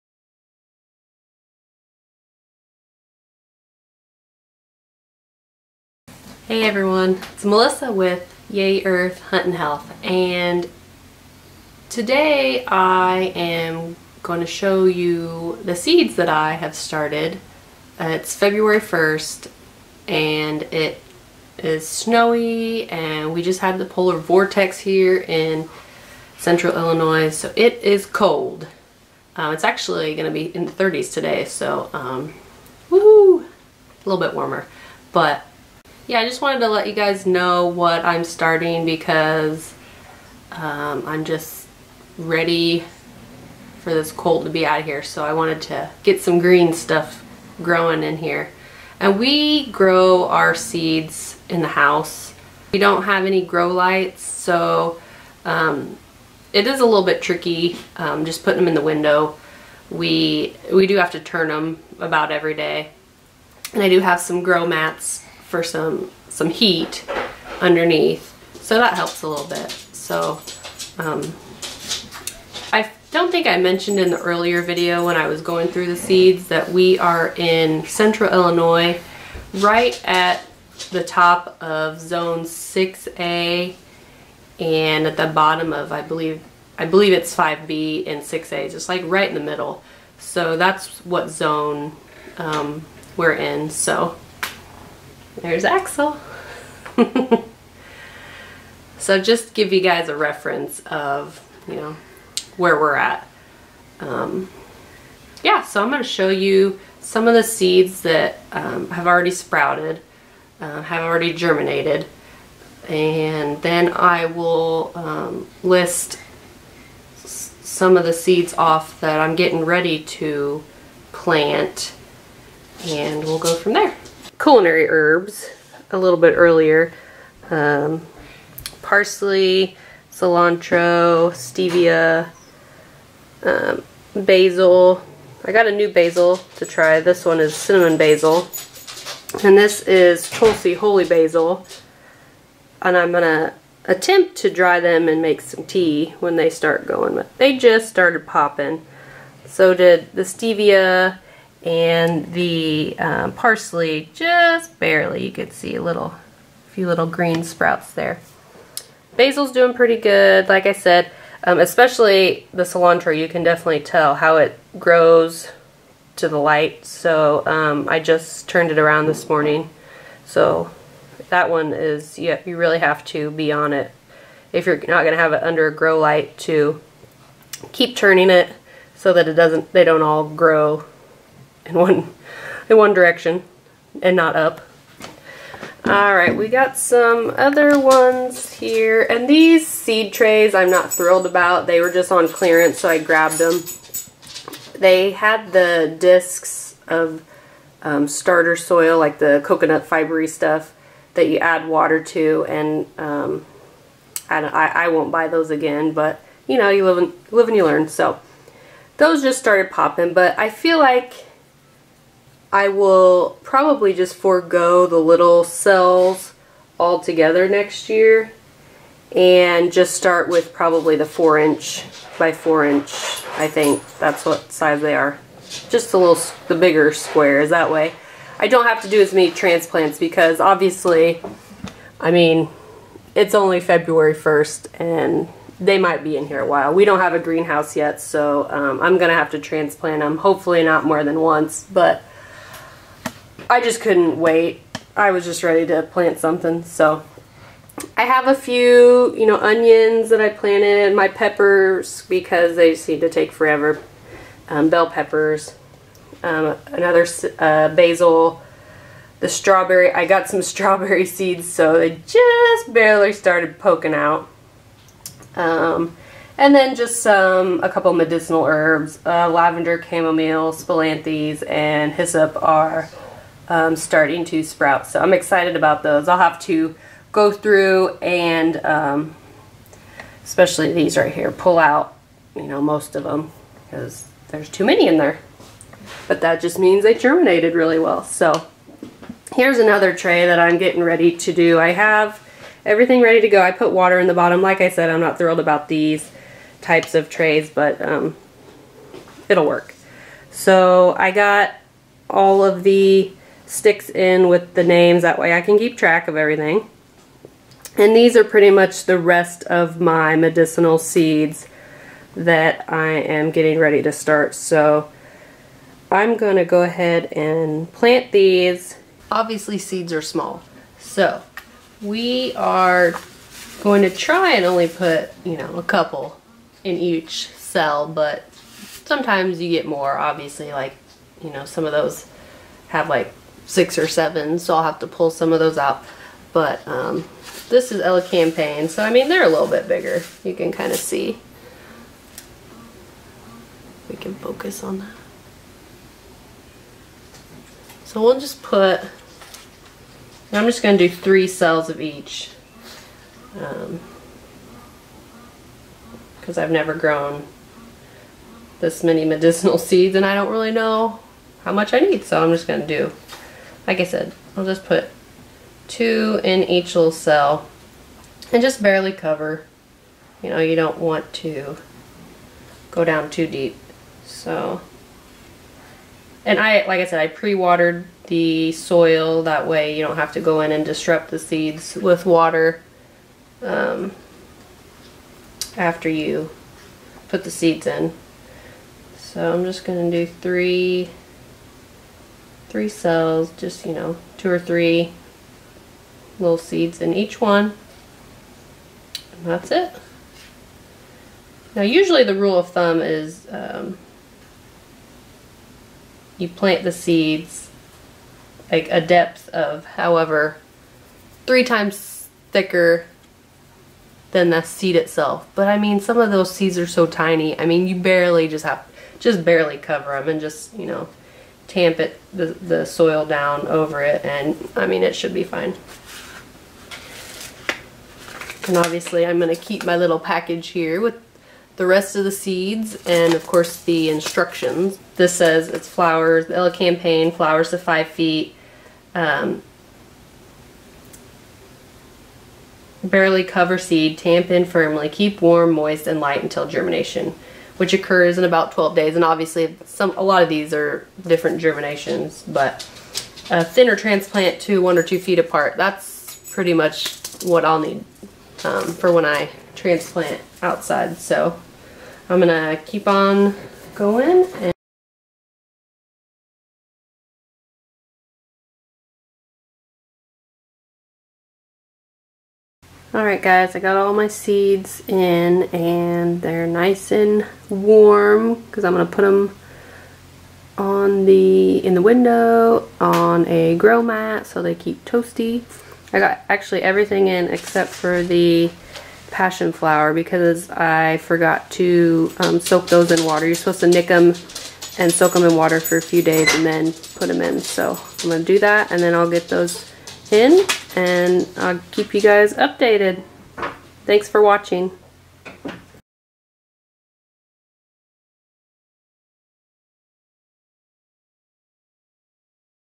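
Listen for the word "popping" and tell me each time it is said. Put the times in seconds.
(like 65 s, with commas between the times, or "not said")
148 s, 209 s.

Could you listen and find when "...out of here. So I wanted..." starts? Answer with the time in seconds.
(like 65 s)
44 s.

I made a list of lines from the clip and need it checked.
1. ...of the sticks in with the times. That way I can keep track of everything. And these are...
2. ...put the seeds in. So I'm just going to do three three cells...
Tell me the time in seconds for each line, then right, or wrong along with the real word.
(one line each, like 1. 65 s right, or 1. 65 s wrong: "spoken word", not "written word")
1. 302 s wrong: "names", not "times"
2. 387 s right.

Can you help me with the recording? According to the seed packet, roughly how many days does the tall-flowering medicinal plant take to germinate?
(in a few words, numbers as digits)
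12 days.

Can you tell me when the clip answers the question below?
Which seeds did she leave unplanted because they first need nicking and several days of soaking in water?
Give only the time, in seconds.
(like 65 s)
489 s.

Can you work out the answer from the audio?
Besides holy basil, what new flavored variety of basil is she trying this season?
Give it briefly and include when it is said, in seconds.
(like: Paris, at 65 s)
cinnamon basil, at 137 s.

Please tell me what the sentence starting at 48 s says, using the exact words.
And we grow our seeds in the house.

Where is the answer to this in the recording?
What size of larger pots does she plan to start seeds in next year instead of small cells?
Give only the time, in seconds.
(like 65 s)
221 s.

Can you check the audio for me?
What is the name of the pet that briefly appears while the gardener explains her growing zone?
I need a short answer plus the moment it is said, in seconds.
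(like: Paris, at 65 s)
Axel, at 95 s.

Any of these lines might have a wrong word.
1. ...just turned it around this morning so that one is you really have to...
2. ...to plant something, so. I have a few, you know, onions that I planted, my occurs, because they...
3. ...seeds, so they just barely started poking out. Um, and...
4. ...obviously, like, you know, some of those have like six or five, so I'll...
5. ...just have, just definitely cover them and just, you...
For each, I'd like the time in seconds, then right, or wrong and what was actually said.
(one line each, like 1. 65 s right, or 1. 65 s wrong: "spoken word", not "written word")
1. 167 s right
2. 245 s wrong: "peppers", not "occurs"
3. 261 s right
4. 329 s wrong: "seven", not "five"
5. 418 s wrong: "barely", not "definitely".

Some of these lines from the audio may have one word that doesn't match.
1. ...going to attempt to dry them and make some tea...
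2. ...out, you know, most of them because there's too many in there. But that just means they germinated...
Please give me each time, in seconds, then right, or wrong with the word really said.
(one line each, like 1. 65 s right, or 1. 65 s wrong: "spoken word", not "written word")
1. 143 s right
2. 281 s right.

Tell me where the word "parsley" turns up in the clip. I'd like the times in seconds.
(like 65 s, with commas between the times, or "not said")
128 s, 153 s.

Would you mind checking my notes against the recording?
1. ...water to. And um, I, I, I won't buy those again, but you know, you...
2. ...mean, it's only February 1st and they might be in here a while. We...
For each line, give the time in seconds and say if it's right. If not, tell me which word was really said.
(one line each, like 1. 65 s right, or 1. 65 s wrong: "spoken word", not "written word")
1. 201 s right
2. 232 s right.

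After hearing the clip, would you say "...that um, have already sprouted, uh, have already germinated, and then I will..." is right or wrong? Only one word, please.
right.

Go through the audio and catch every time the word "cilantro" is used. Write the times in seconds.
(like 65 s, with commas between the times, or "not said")
130 s, 162 s.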